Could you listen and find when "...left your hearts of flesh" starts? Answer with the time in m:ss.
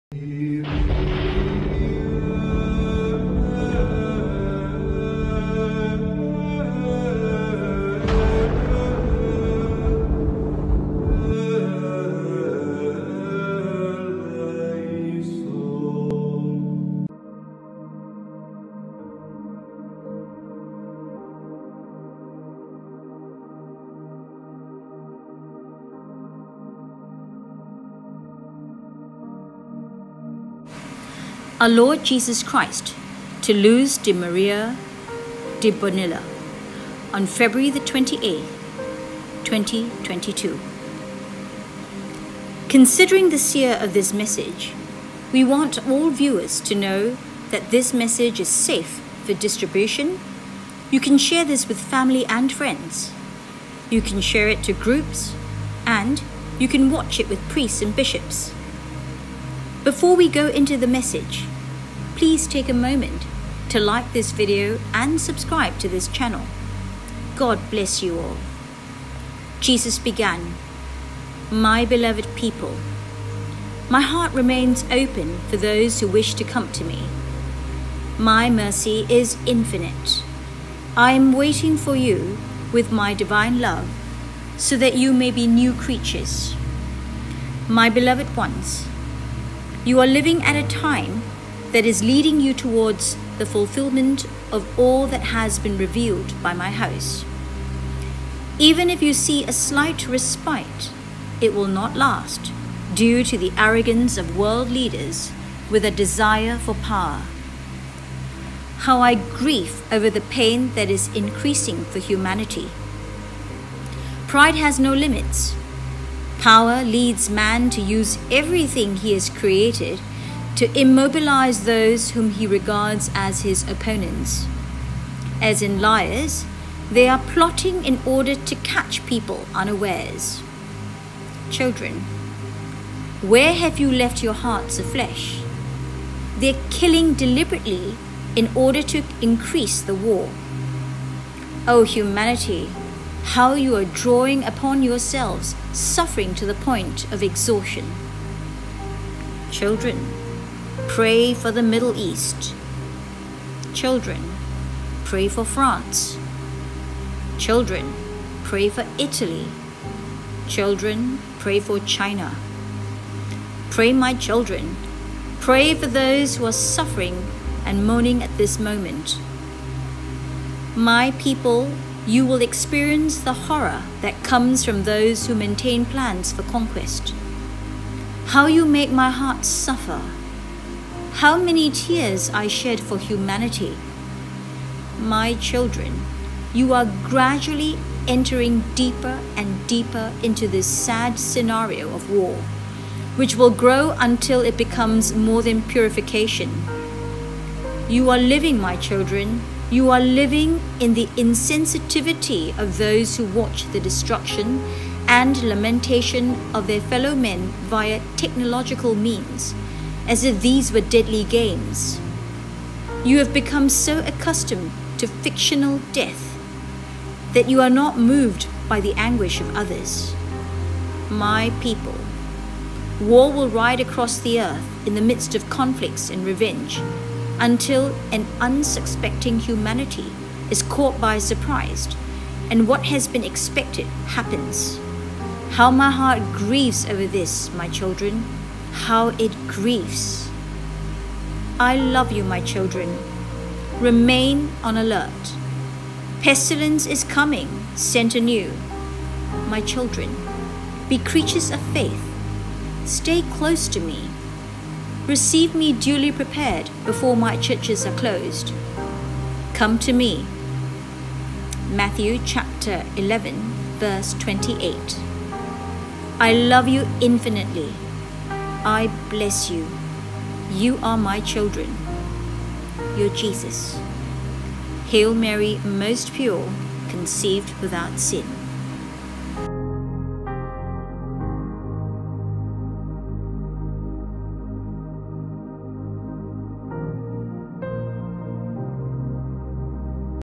2:13.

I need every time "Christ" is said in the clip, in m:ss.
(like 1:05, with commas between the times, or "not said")
0:32.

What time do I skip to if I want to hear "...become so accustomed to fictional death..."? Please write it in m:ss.
3:33.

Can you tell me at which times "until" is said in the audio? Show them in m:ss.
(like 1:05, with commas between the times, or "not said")
3:13, 3:47.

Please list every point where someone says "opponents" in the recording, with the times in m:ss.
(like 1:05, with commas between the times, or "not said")
2:03.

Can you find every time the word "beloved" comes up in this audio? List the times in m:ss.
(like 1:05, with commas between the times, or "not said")
1:11, 1:27.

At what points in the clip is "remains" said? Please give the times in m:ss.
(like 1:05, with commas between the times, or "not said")
1:14, 4:03.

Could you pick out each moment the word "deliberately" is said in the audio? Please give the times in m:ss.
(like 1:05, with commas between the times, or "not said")
2:17.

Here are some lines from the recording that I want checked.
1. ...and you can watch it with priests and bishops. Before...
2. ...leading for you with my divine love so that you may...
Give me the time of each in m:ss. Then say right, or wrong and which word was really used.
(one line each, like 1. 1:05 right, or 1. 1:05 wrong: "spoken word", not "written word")
1. 0:55 right
2. 1:21 wrong: "waiting", not "leading".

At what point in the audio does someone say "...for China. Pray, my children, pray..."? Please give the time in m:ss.
2:41.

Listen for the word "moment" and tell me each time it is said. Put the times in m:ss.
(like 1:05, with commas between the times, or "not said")
1:02, 2:48.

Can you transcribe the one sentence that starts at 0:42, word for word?
Considering the seer of this message, we want all viewers to know that this message is safe for distribution.